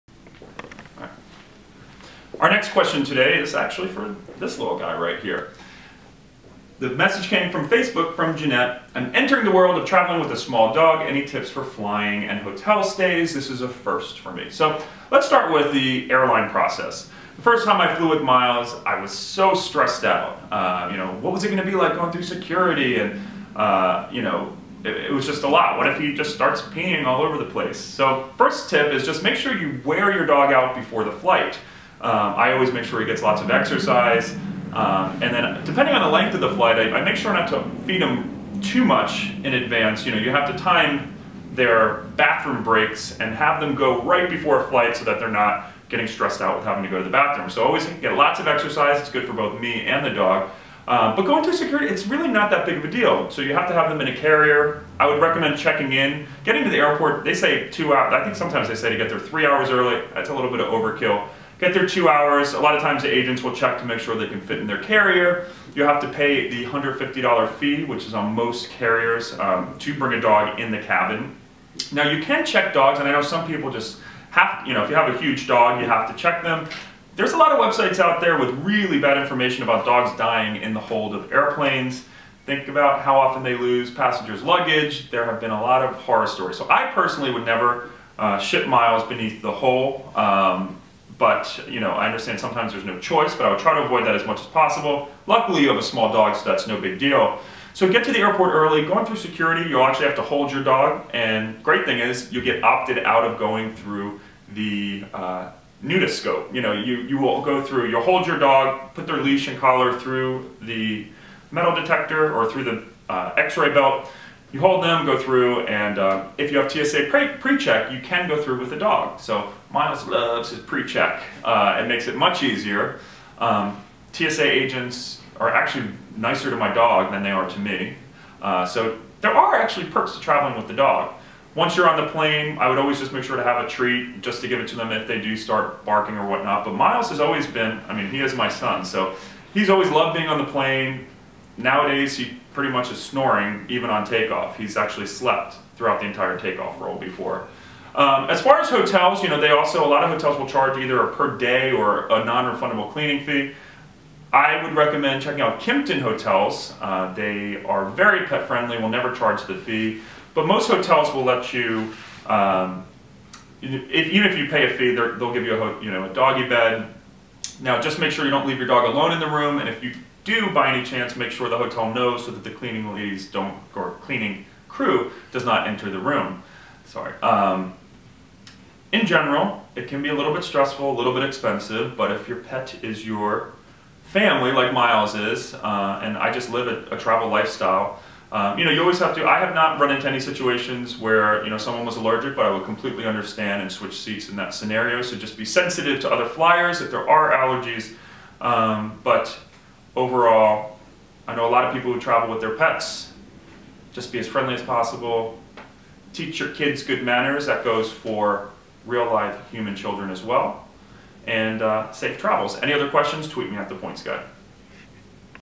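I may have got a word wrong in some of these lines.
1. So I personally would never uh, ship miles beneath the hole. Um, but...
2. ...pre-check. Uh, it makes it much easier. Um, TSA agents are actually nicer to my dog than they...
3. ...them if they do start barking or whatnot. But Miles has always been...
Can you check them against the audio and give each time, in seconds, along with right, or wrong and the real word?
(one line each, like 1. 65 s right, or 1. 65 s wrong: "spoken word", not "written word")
1. 86 s right
2. 120 s right
3. 134 s right.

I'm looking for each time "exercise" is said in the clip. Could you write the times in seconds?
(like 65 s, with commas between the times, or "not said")
33 s, 48 s.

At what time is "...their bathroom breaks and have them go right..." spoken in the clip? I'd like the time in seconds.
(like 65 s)
41 s.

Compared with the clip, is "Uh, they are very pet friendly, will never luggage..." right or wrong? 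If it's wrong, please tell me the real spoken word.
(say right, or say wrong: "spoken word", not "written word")
wrong: "charge", not "luggage".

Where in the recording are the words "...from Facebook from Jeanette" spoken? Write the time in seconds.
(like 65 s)
7 s.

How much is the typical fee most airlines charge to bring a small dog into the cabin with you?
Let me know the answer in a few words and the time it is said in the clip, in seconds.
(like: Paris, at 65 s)
$150, at 66 s.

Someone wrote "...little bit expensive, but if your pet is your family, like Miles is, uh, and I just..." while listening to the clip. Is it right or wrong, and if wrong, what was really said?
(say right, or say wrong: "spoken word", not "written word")
right.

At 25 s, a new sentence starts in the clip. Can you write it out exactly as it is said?
What if he just starts peeing all over the place?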